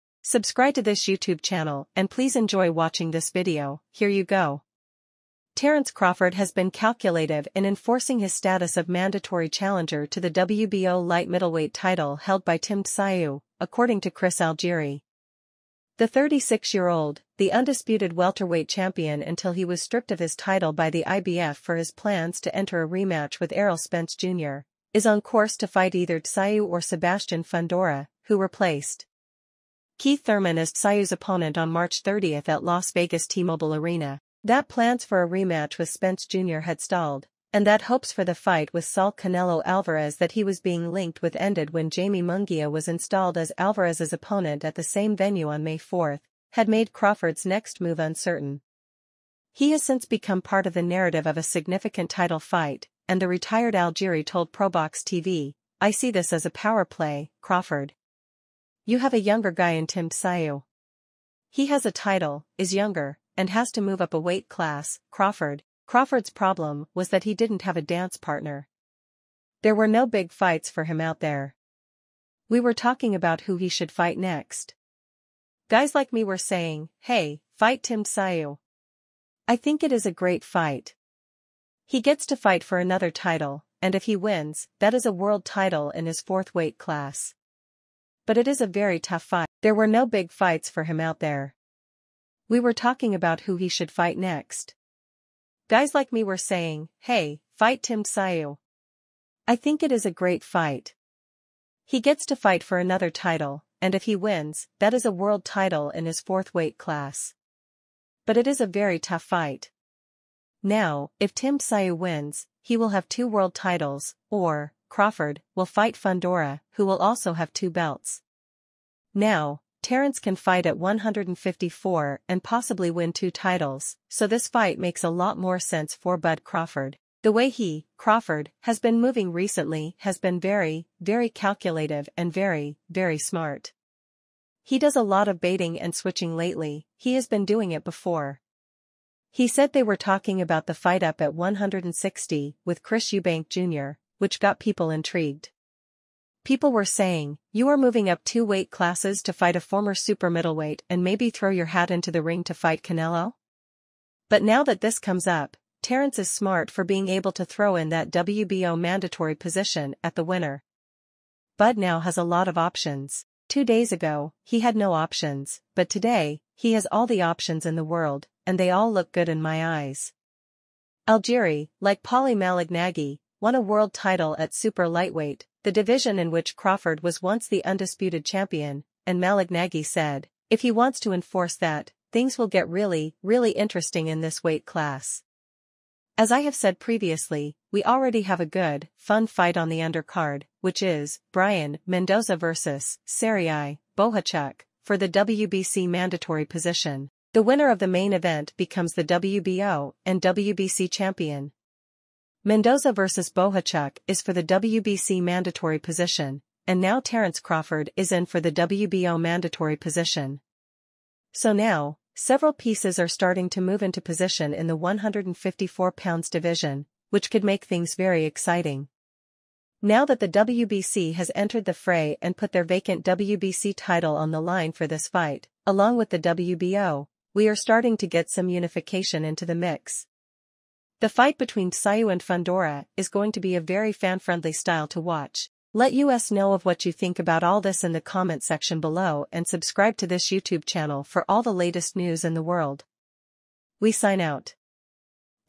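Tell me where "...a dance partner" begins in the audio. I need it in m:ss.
1:07.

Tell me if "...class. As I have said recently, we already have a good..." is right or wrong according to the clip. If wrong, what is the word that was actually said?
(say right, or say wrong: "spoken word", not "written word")
wrong: "previously", not "recently".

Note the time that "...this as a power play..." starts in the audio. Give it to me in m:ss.
0:56.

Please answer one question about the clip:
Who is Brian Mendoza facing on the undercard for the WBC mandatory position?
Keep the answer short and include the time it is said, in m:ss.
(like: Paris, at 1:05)
Serhii Bohachuk, at 3:13.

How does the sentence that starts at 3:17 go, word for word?
The winner of the main event becomes the WBO and WBC champion, Mendoza vs.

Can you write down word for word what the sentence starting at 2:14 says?
He does a lot of baiting and switching lately, he has been doing it before.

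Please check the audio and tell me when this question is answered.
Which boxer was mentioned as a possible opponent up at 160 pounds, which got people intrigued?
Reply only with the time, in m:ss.
2:22.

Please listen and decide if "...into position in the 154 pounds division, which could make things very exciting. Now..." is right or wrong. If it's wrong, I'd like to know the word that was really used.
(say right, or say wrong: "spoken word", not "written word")
right.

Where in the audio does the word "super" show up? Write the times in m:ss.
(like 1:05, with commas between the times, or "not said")
2:29, 2:54.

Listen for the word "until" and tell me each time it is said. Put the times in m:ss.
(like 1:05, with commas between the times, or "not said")
0:19.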